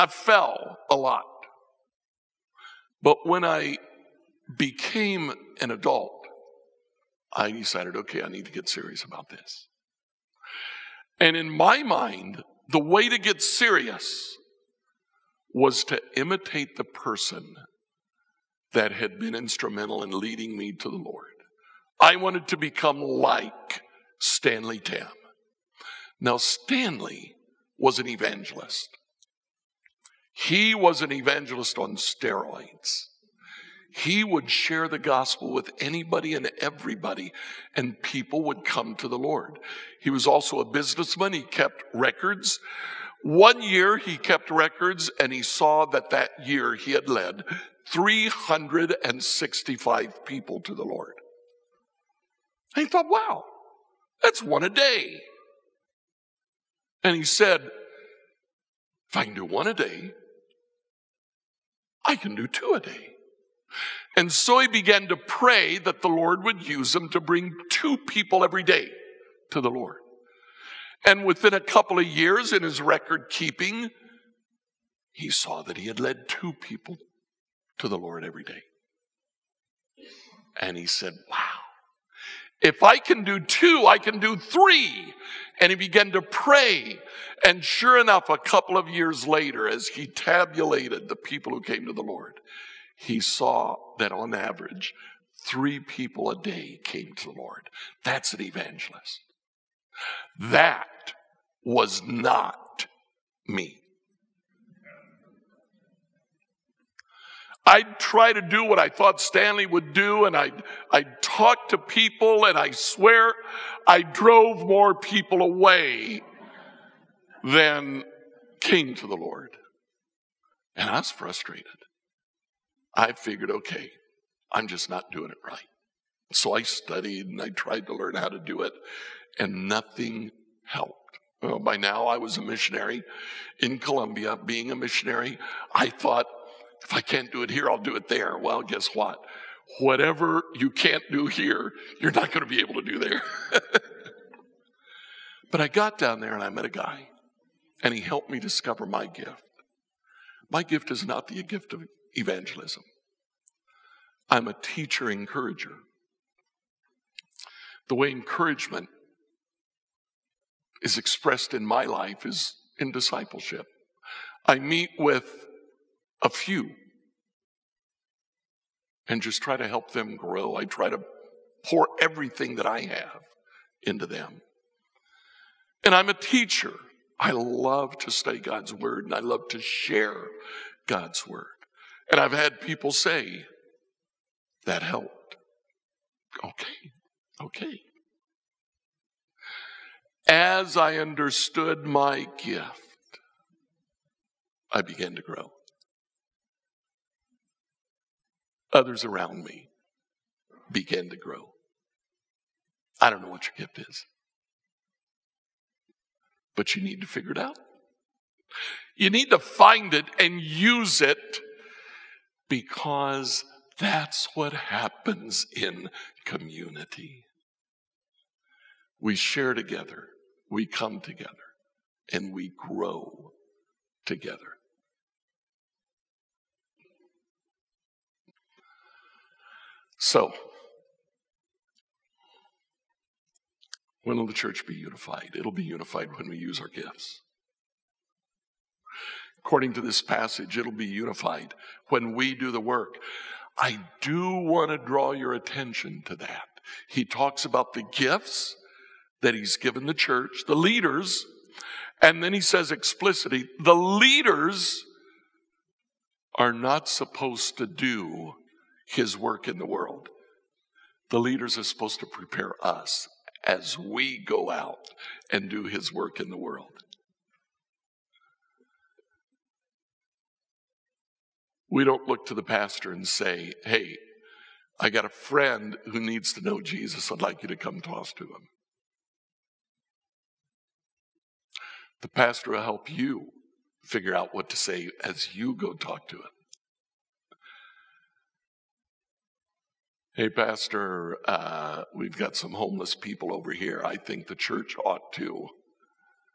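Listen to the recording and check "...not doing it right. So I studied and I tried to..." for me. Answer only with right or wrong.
right.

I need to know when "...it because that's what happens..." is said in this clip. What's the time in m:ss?
3:30.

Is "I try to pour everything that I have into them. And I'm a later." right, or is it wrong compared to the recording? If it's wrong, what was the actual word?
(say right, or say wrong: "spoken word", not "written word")
wrong: "teacher", not "later".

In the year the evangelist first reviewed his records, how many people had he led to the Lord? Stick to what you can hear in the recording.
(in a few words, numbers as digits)
365.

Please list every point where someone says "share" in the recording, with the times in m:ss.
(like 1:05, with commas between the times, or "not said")
0:34, 2:59, 3:39.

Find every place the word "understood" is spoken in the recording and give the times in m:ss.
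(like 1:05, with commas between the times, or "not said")
3:10.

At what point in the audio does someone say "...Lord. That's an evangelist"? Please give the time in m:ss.
1:37.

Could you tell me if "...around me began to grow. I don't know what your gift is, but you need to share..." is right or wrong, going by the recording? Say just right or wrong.
wrong.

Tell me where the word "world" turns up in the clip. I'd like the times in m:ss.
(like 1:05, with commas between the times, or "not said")
4:19, 4:26.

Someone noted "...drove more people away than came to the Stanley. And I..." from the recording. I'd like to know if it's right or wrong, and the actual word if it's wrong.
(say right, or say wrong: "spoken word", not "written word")
wrong: "Lord", not "Stanley".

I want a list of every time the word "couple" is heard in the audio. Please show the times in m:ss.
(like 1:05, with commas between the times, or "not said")
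1:11, 1:28.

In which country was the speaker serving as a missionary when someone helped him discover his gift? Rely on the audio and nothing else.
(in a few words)
Colombia.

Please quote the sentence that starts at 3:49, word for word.
So, when will the church be unified?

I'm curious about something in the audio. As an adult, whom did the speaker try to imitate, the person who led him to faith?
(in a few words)
Stanley Tam.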